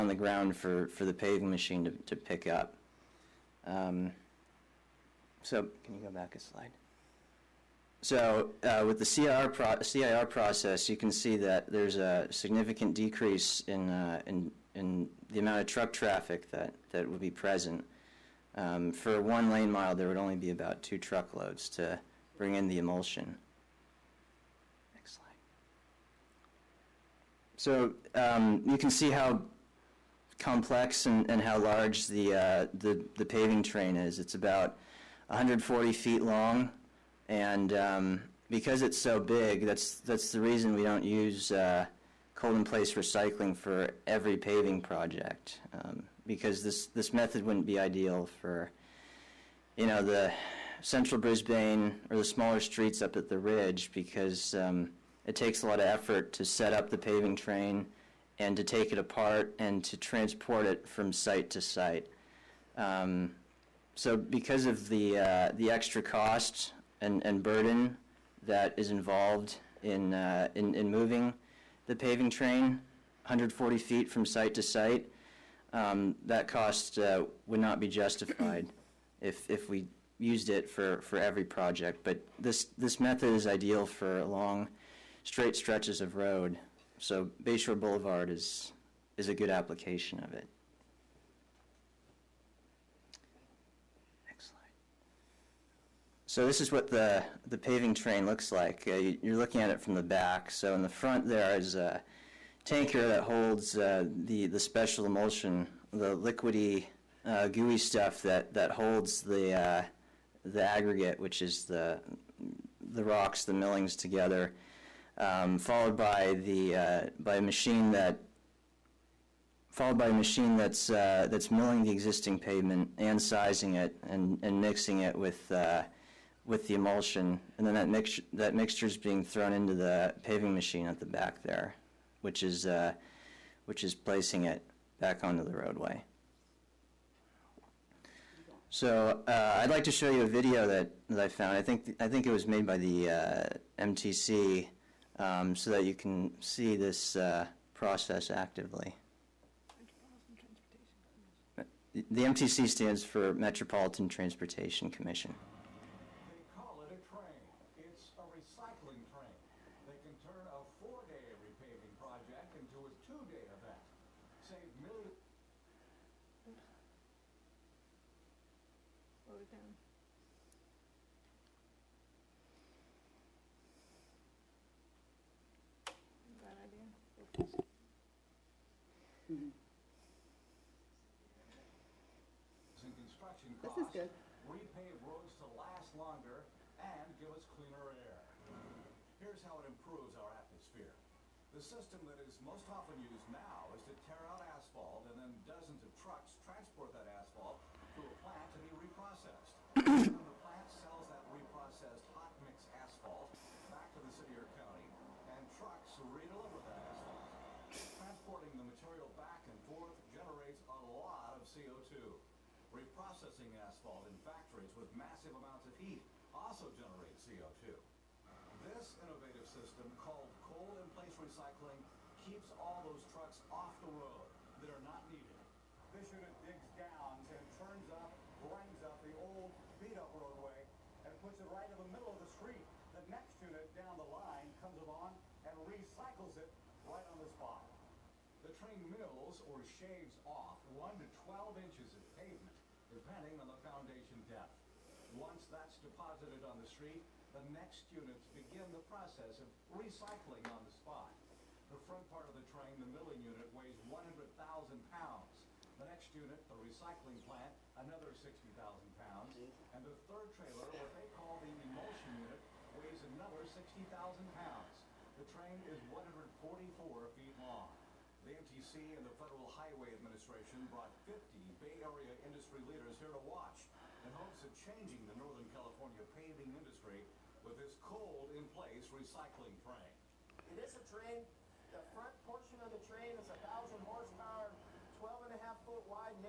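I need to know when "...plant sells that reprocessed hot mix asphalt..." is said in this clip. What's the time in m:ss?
3:20.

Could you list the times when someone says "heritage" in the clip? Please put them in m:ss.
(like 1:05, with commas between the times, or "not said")
not said.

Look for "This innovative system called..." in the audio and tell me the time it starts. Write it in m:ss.
3:38.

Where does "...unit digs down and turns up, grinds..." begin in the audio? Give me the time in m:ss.
3:46.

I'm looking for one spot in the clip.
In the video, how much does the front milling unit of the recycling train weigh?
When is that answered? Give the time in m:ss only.
4:13.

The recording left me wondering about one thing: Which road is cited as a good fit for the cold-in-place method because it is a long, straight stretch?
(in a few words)
Bayshore Boulevard.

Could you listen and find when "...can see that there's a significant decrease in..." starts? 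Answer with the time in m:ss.
0:10.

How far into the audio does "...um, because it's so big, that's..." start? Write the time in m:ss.
0:37.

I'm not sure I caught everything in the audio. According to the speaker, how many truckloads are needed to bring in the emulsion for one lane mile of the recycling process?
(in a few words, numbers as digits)
2.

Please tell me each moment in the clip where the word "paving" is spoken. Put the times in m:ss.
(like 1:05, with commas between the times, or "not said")
0:01, 0:33, 0:44, 0:56, 1:11, 1:37, 2:10, 4:36.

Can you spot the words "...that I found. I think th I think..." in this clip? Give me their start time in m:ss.
2:21.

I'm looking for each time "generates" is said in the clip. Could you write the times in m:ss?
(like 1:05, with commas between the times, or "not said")
3:30, 3:36.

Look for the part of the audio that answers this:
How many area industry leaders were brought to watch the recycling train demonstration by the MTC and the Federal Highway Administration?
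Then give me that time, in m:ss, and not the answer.
4:31.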